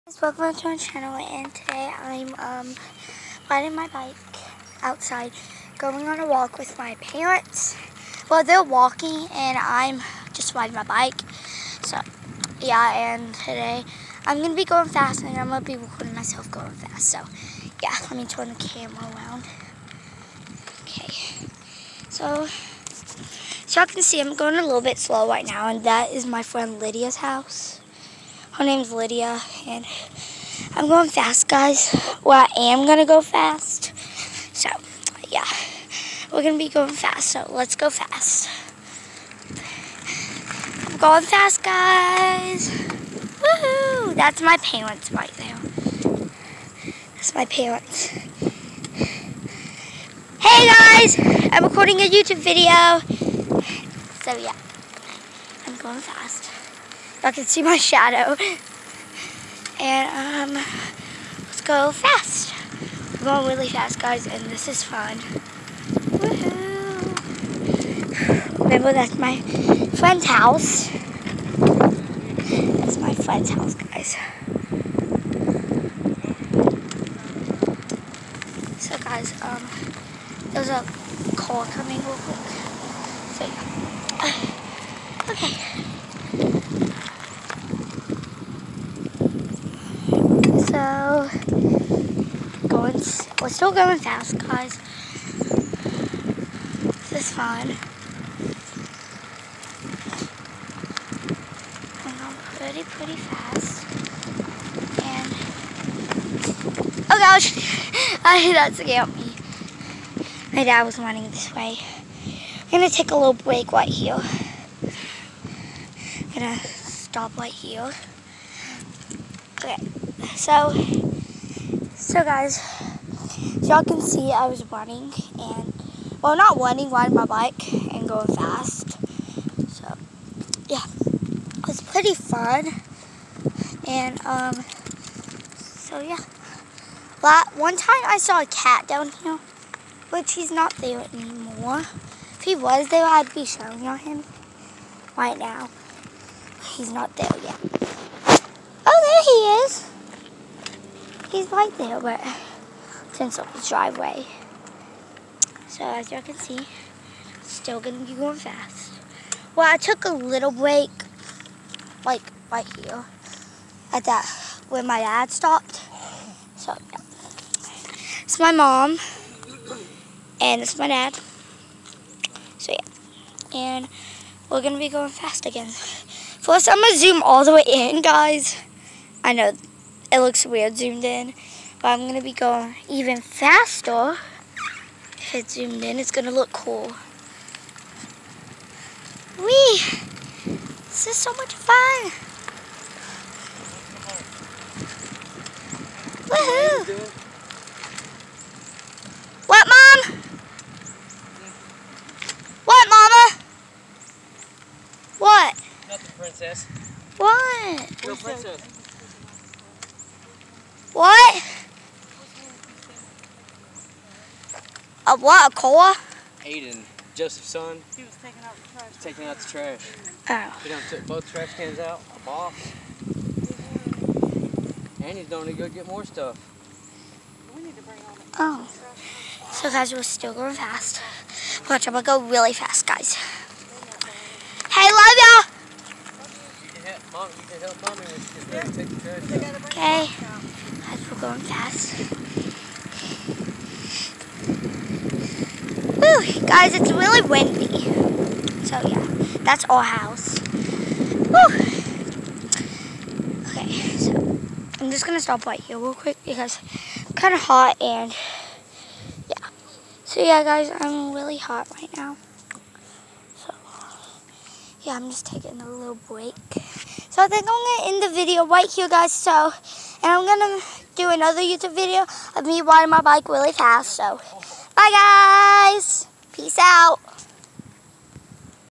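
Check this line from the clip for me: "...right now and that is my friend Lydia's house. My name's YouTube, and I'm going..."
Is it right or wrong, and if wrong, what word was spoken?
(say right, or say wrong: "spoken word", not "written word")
wrong: "Lydia", not "YouTube".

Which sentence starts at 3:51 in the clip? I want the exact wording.
Watch, I'm going to go really fast, guys.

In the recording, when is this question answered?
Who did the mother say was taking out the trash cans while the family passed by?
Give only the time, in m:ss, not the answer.
3:36.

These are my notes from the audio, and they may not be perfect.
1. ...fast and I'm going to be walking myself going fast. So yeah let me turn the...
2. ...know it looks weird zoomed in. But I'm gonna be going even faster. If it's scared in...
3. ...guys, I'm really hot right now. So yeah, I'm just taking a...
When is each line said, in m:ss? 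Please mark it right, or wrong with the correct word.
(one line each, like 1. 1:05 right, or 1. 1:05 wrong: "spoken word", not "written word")
1. 0:14 wrong: "recording", not "walking"
2. 2:59 wrong: "zoomed", not "scared"
3. 4:20 right.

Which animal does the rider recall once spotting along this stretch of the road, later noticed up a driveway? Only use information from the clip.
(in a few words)
A cat.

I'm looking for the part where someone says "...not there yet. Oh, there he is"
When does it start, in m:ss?
2:26.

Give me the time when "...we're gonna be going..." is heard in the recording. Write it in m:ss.
2:54.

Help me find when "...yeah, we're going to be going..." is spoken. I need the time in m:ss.
0:35.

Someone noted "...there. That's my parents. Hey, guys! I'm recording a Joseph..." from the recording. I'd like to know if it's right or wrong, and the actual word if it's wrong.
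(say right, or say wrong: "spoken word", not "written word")
wrong: "YouTube", not "Joseph".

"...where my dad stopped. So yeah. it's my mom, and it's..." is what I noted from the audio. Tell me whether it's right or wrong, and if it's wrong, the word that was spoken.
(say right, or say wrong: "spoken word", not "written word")
right.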